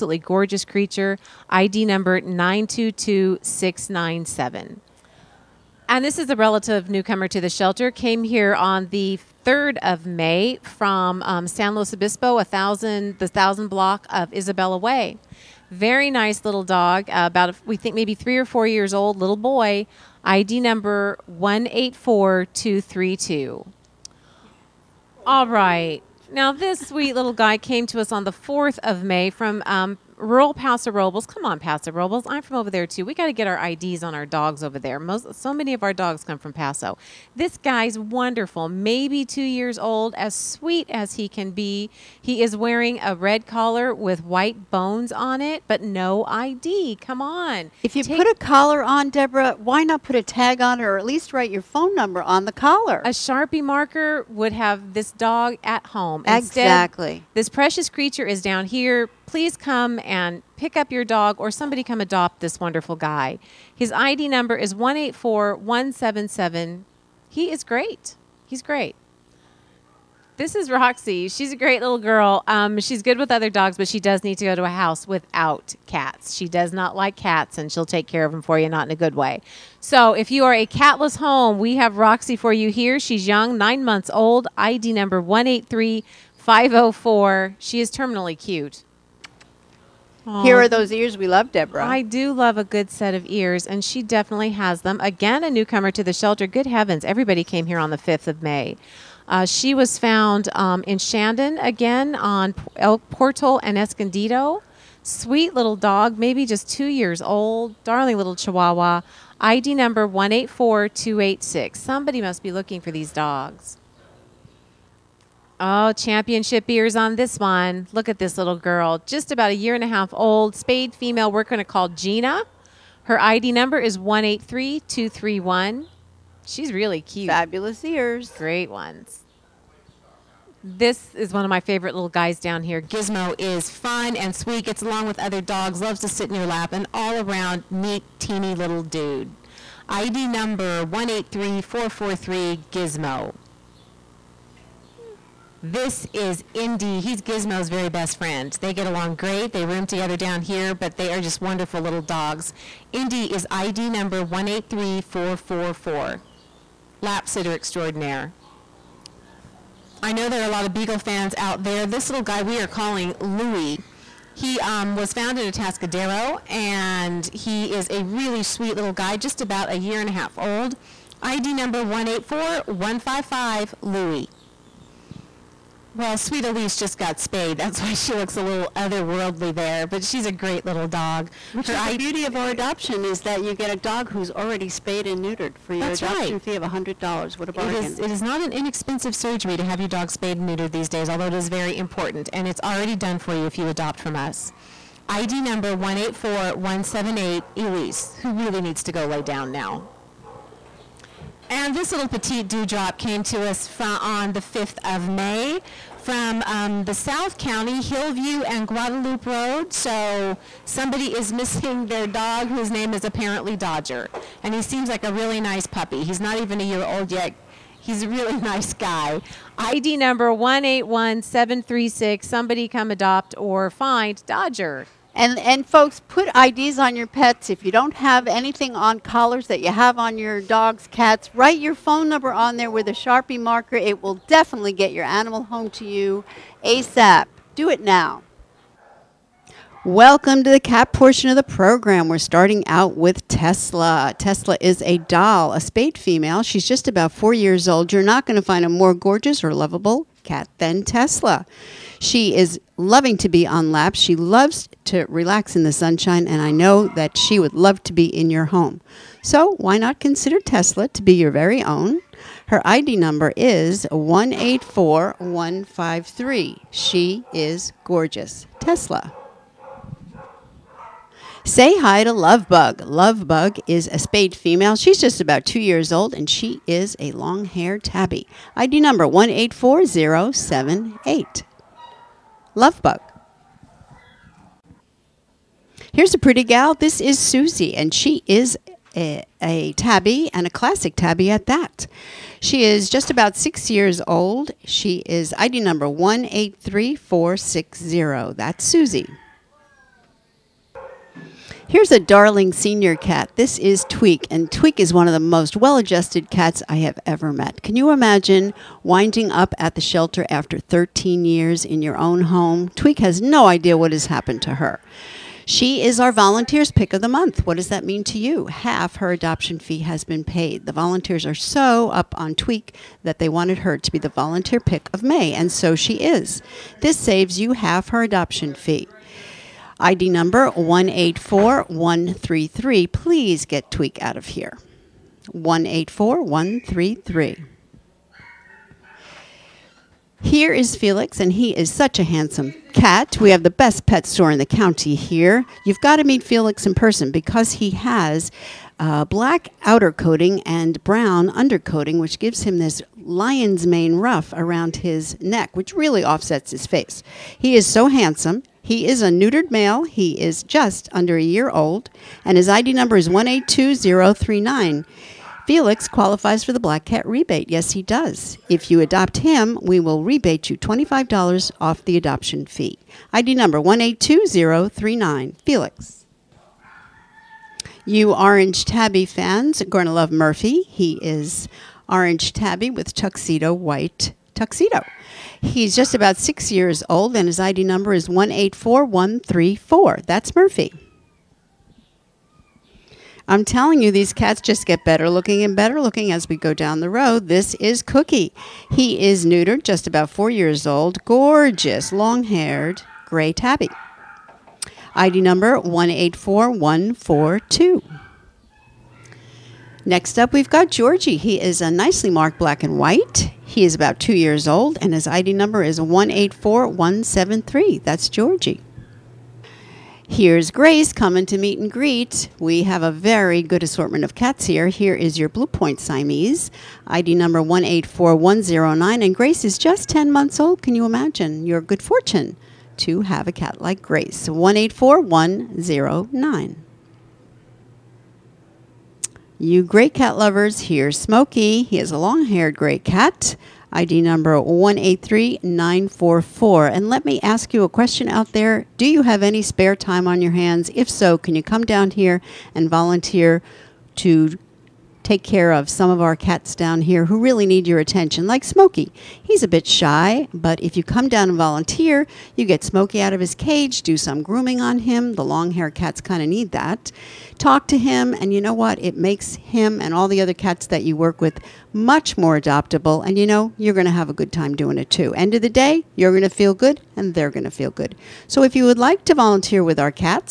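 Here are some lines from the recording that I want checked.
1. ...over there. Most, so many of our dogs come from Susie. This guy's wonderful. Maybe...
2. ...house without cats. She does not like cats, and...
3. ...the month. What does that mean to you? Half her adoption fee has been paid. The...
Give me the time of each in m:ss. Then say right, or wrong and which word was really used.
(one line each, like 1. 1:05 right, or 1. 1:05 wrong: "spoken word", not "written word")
1. 0:34 wrong: "Paso", not "Susie"
2. 1:14 right
3. 5:17 right.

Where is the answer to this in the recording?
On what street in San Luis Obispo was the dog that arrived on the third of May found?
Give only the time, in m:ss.
0:14.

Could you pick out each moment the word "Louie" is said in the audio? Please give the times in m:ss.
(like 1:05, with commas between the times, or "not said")
2:43, 2:53.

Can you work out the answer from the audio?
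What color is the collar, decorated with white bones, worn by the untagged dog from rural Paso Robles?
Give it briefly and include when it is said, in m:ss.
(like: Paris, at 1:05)
Red, at 0:43.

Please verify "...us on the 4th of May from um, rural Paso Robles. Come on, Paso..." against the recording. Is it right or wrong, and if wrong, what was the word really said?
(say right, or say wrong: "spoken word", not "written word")
right.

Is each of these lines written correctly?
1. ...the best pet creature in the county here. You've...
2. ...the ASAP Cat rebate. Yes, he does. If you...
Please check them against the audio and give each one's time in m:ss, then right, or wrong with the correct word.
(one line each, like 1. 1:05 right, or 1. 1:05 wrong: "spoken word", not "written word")
1. 5:43 wrong: "store", not "creature"
2. 6:06 wrong: "Black", not "ASAP".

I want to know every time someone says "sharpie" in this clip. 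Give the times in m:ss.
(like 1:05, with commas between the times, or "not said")
0:53, 3:52.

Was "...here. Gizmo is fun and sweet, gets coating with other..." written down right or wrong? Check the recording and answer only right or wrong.
wrong.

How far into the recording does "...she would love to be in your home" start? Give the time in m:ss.
4:17.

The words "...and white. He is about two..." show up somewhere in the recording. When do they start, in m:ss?
6:52.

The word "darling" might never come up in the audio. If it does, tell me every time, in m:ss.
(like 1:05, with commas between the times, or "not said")
1:47, 5:01.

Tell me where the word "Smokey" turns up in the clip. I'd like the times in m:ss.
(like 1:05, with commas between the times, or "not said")
7:20, 7:38, 7:42.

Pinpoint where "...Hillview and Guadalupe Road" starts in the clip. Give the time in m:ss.
3:27.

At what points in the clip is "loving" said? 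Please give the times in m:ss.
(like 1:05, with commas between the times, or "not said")
4:12.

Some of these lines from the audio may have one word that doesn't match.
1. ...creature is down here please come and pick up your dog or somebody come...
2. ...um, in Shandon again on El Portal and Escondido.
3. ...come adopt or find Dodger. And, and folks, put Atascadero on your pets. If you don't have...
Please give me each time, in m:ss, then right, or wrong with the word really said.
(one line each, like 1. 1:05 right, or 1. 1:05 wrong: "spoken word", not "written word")
1. 0:57 right
2. 1:40 right
3. 3:42 wrong: "IDs", not "Atascadero".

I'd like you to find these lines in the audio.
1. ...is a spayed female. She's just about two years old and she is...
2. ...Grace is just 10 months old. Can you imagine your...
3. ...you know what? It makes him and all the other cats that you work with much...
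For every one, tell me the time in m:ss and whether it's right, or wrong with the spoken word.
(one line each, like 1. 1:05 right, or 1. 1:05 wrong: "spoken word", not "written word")
1. 4:33 right
2. 7:09 right
3. 7:48 right.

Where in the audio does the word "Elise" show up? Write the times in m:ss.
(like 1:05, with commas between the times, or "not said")
2:56, 3:17.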